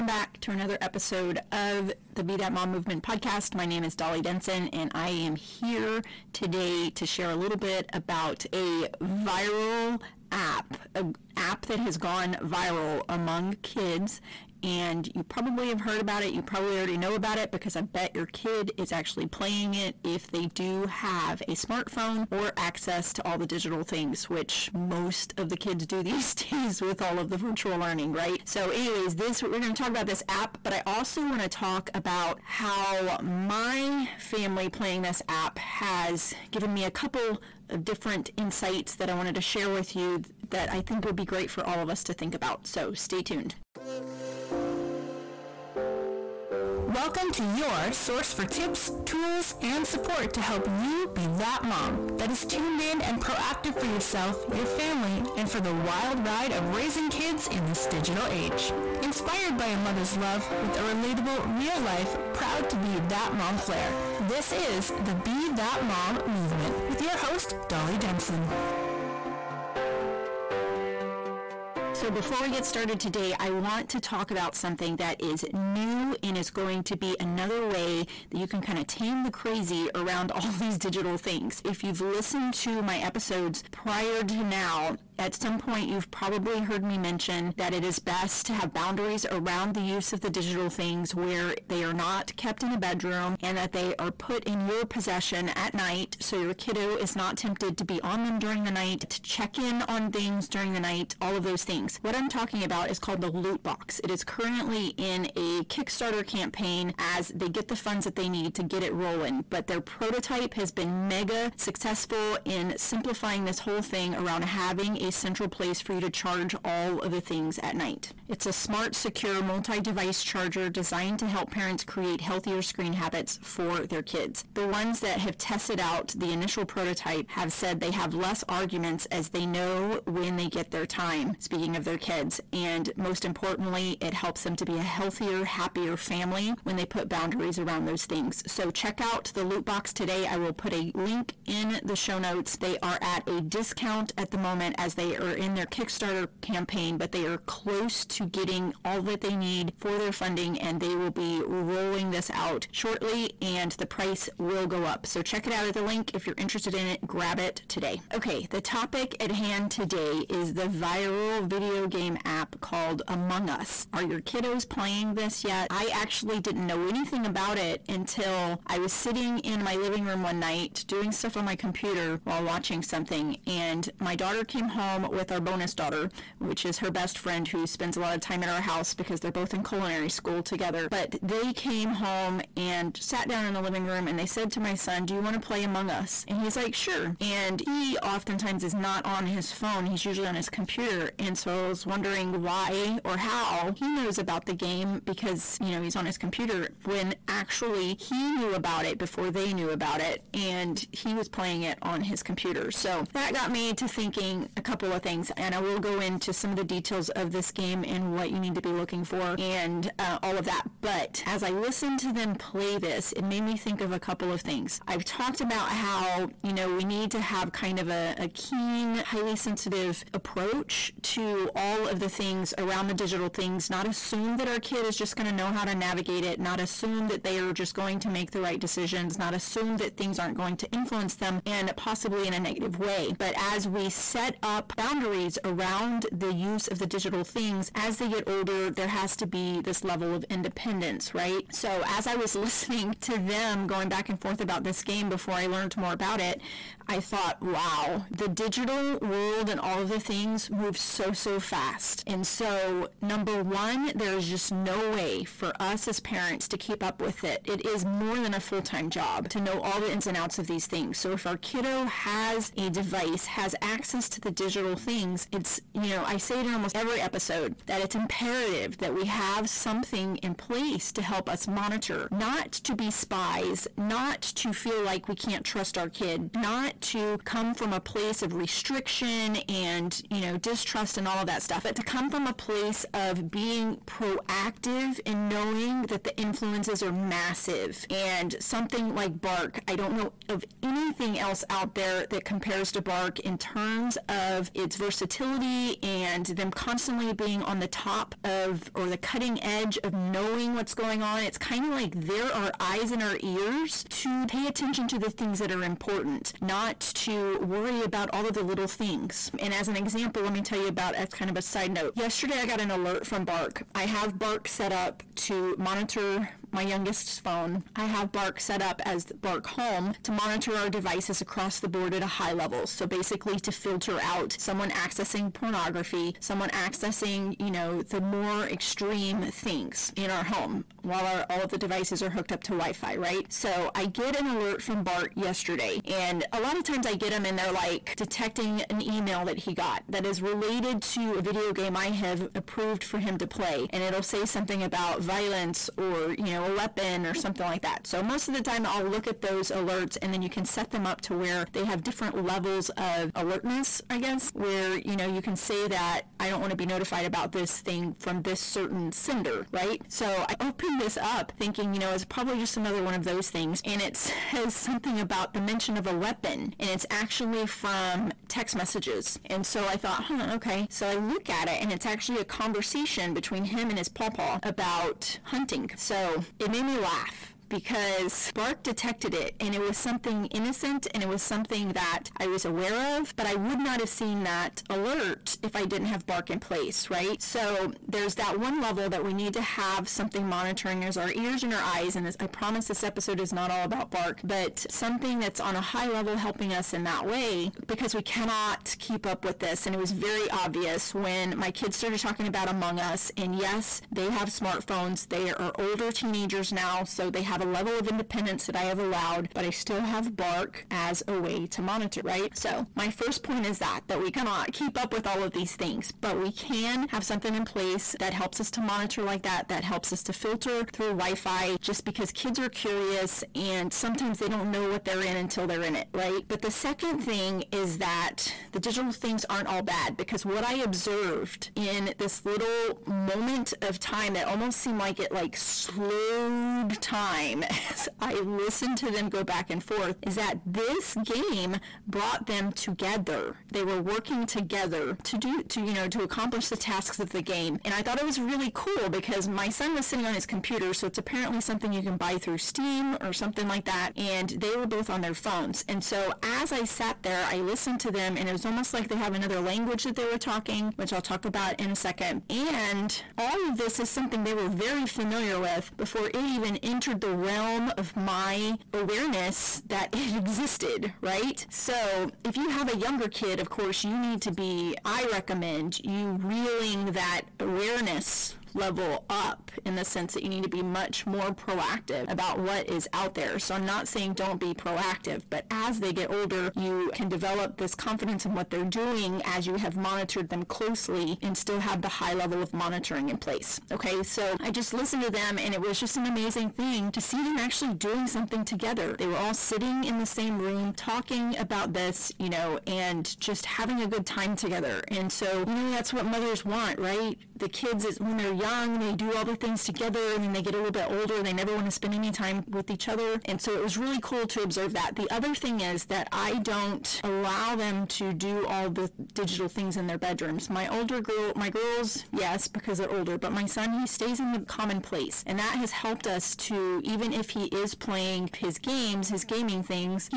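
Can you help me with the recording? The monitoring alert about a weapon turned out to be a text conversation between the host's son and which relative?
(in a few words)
his pawpaw.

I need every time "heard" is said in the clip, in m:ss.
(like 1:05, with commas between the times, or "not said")
0:15, 1:26.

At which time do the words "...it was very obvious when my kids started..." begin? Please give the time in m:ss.
6:39.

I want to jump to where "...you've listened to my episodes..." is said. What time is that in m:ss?
1:21.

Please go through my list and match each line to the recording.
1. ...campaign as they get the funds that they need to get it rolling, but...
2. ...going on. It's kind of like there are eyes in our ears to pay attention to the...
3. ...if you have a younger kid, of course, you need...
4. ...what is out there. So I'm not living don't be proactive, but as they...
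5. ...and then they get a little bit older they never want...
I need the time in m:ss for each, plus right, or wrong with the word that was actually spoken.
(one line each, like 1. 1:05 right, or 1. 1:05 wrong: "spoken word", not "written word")
1. 1:46 right
2. 5:00 right
3. 7:52 right
4. 8:02 wrong: "saying", not "living"
5. 8:30 right.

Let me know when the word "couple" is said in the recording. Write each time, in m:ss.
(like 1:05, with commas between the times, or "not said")
0:36, 3:24, 3:33.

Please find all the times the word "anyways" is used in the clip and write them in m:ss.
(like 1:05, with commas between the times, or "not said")
0:28.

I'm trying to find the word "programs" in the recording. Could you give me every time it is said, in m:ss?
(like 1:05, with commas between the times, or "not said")
not said.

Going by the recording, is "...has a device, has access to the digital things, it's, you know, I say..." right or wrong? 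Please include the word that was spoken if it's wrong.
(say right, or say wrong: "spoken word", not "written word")
right.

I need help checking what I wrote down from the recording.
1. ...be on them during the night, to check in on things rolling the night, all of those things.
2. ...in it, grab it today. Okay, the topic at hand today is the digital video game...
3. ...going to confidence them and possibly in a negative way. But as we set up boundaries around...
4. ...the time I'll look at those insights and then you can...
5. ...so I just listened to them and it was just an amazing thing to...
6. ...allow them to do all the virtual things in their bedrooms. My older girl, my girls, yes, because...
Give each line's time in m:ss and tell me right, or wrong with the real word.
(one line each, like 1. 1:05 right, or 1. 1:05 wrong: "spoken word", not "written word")
1. 1:37 wrong: "during", not "rolling"
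2. 2:36 wrong: "viral", not "digital"
3. 3:50 wrong: "influence", not "confidence"
4. 5:48 wrong: "alerts", not "insights"
5. 8:14 right
6. 8:37 wrong: "digital", not "virtual".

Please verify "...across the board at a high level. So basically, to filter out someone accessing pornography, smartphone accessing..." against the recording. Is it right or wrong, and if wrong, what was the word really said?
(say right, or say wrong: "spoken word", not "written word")
wrong: "someone", not "smartphone".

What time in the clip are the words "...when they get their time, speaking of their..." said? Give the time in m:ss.
2:10.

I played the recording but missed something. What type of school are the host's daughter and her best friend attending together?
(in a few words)
culinary school.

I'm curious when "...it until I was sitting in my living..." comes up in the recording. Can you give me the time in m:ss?
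2:47.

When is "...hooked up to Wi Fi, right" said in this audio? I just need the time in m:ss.
5:32.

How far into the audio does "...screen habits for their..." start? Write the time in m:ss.
2:02.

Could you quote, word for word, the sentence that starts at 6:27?
So there's that one level that we need to have something monitoring as our ears and our eyes.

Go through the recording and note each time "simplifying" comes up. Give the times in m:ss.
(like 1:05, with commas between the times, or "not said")
1:52.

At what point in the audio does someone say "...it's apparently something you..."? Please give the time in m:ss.
7:30.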